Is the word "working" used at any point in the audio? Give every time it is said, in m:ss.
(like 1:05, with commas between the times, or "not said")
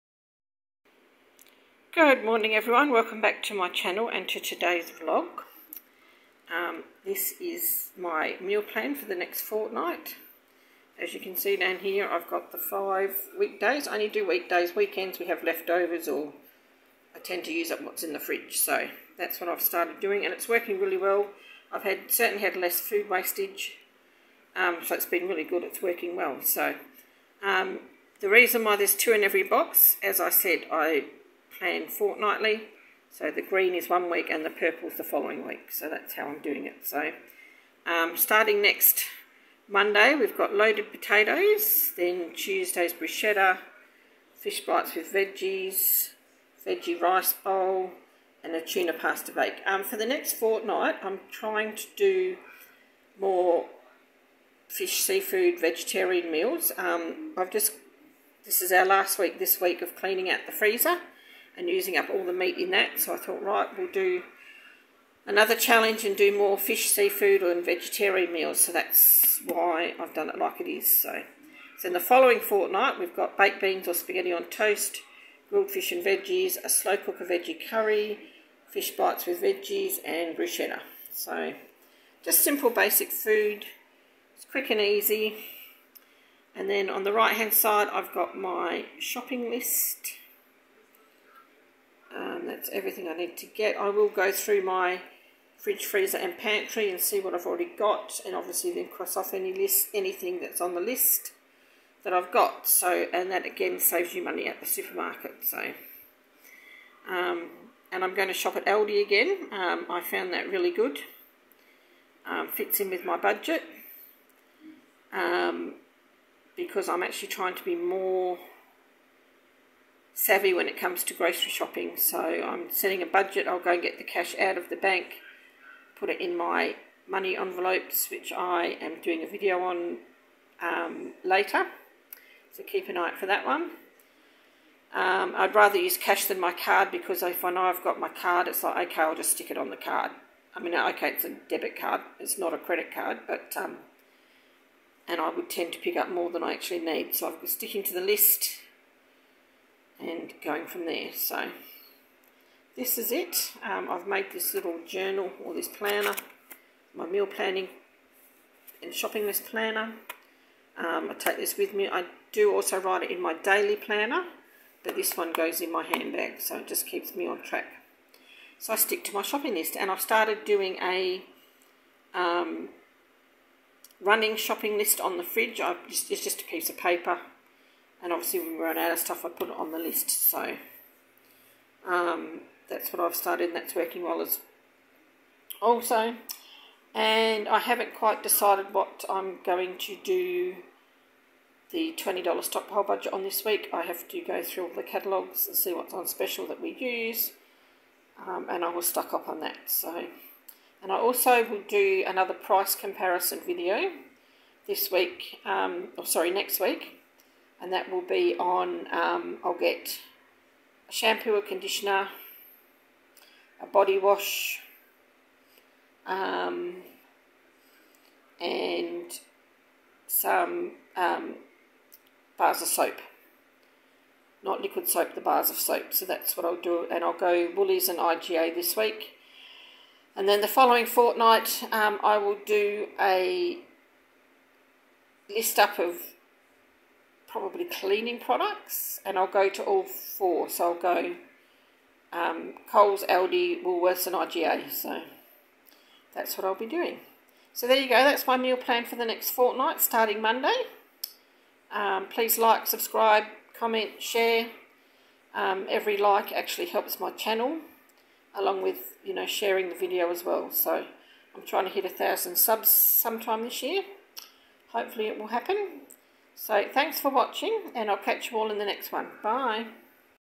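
0:20, 0:25, 3:03.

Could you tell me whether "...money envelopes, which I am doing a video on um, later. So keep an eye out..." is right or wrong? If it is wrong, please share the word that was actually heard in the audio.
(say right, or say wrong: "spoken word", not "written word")
right.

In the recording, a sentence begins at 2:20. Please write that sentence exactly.
I mean, okay, it's a debit card.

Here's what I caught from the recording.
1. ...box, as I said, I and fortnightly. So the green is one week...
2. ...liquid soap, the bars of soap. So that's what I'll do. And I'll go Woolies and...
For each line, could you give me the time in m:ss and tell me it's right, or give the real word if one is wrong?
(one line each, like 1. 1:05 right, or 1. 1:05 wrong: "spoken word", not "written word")
1. 0:29 right
2. 3:44 right.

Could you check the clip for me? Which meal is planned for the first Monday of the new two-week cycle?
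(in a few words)
Loaded potatoes.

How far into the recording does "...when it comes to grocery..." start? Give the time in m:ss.
2:00.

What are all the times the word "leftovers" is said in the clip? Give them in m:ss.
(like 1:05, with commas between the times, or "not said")
0:15.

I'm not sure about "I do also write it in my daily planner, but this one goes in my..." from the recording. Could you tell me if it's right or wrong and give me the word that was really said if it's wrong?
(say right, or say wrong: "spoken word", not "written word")
right.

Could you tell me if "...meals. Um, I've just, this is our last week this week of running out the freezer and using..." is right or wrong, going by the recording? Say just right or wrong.
wrong.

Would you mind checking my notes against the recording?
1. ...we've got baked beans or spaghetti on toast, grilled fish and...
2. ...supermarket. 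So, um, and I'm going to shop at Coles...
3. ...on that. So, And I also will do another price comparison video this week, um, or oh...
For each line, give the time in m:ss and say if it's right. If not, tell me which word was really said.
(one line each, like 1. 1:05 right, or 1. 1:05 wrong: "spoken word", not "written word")
1. 1:12 right
2. 1:44 wrong: "Aldi", not "Coles"
3. 3:19 right.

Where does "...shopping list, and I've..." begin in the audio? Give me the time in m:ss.
2:49.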